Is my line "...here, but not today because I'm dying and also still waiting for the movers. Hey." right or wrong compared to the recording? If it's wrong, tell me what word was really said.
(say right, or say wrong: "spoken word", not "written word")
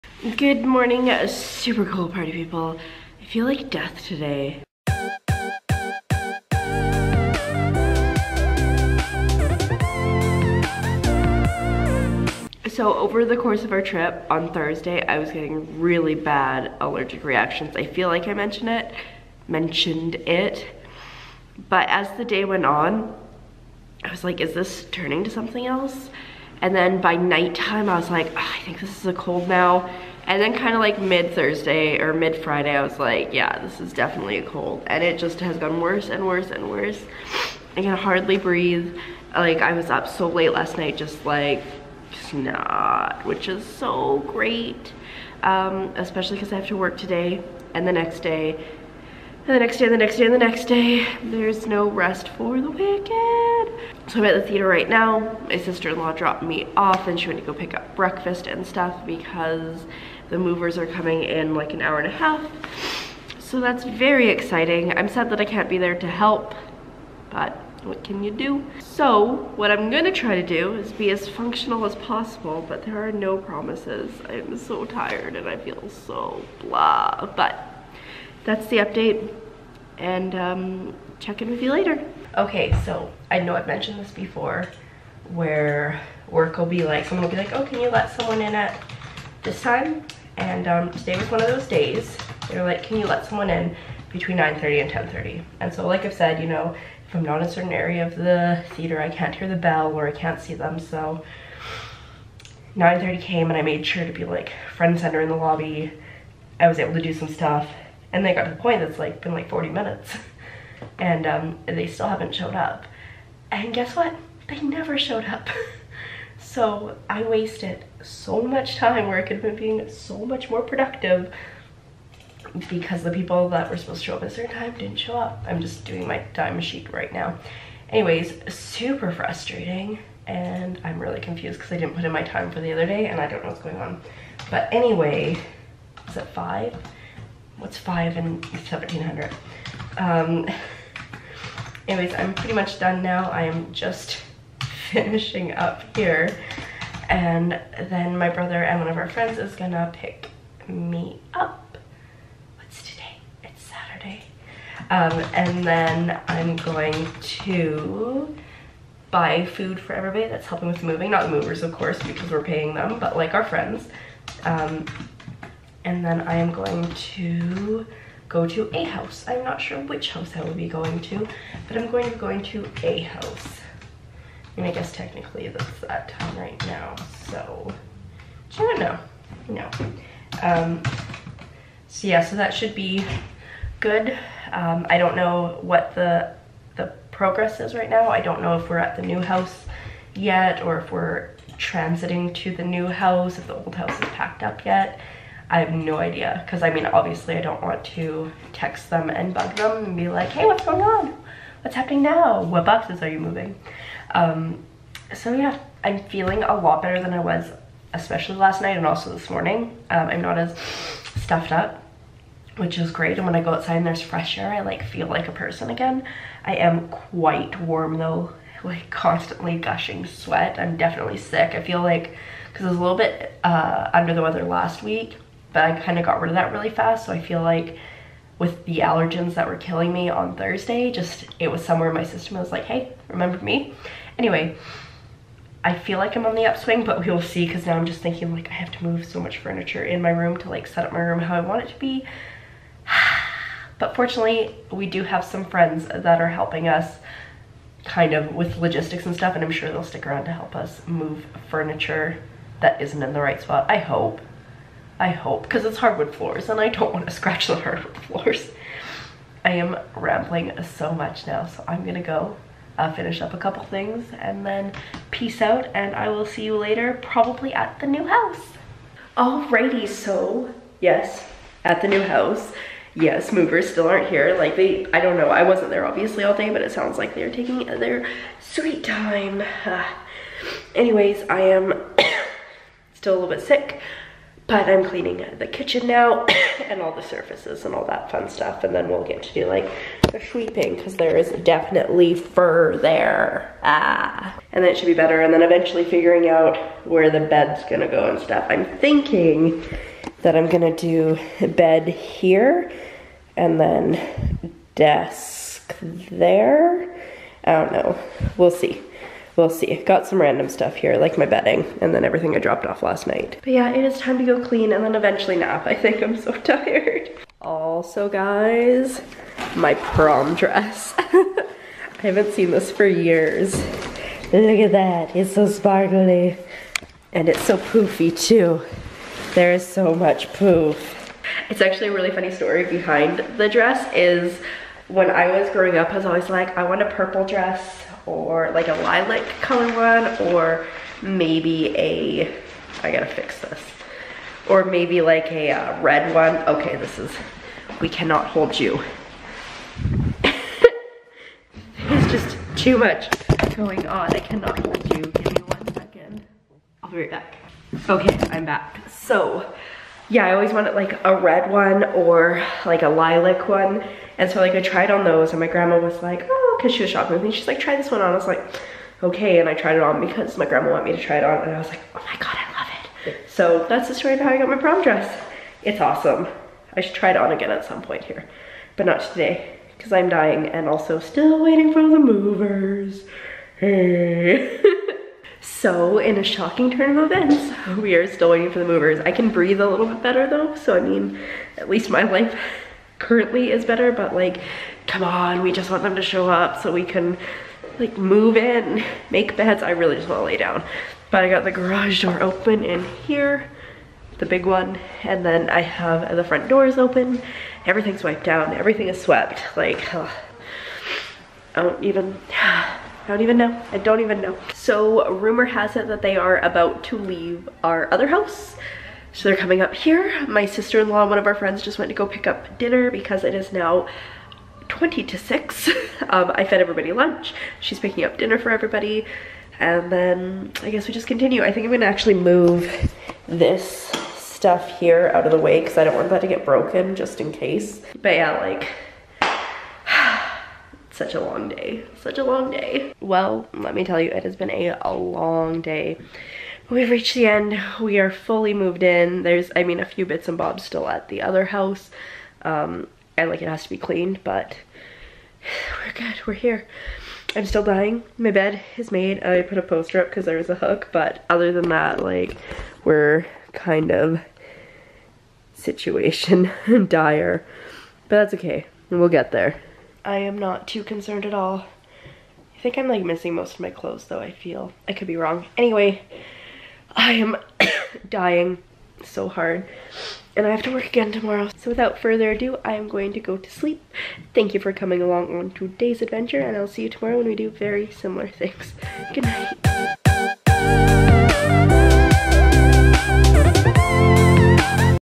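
right.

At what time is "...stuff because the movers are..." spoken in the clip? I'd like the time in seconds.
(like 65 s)
58 s.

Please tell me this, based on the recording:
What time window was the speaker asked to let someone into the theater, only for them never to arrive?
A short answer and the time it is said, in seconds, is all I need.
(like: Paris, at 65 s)
9:30 to 10:30, at 94 s.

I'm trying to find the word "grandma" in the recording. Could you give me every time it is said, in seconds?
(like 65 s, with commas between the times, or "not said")
365 s, 370 s.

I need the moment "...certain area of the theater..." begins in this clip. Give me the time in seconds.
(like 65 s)
97 s.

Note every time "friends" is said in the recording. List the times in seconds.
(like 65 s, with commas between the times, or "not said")
149 s, 163 s, 245 s, 421 s.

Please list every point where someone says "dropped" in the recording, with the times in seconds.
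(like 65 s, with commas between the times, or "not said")
56 s, 312 s.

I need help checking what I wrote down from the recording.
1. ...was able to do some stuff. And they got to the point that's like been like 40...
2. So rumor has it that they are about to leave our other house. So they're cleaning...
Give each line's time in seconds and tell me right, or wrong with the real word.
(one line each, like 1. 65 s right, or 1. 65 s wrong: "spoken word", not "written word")
1. 106 s right
2. 414 s wrong: "coming", not "cleaning".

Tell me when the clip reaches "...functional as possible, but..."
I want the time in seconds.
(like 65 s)
71 s.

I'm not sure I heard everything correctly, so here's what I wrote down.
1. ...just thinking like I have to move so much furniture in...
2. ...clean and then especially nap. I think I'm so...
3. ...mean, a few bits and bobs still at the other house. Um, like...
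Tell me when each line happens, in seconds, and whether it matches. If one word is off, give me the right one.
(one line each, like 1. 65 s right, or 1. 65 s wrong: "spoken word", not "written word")
1. 237 s right
2. 314 s wrong: "eventually", not "especially"
3. 449 s right.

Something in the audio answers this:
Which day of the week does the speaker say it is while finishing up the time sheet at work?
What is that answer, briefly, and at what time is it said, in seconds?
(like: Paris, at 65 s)
Saturday, at 153 s.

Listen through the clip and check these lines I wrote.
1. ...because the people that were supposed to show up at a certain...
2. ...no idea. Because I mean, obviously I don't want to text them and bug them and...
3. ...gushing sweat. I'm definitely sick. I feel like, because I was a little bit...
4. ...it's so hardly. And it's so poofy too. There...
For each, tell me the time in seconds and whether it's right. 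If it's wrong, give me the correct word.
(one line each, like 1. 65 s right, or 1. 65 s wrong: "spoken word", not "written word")
1. 122 s right
2. 195 s right
3. 219 s right
4. 325 s wrong: "sparkly", not "hardly".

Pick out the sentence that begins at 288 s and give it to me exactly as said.
And then we'll get to do like the sweeping because there is definitely fur there.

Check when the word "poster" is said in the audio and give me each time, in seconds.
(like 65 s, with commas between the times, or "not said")
459 s.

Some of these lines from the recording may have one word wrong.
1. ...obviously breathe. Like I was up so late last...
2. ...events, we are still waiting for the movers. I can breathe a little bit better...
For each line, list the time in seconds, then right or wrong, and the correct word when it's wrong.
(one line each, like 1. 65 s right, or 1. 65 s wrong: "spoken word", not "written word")
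1. 37 s wrong: "hardly", not "obviously"
2. 387 s right.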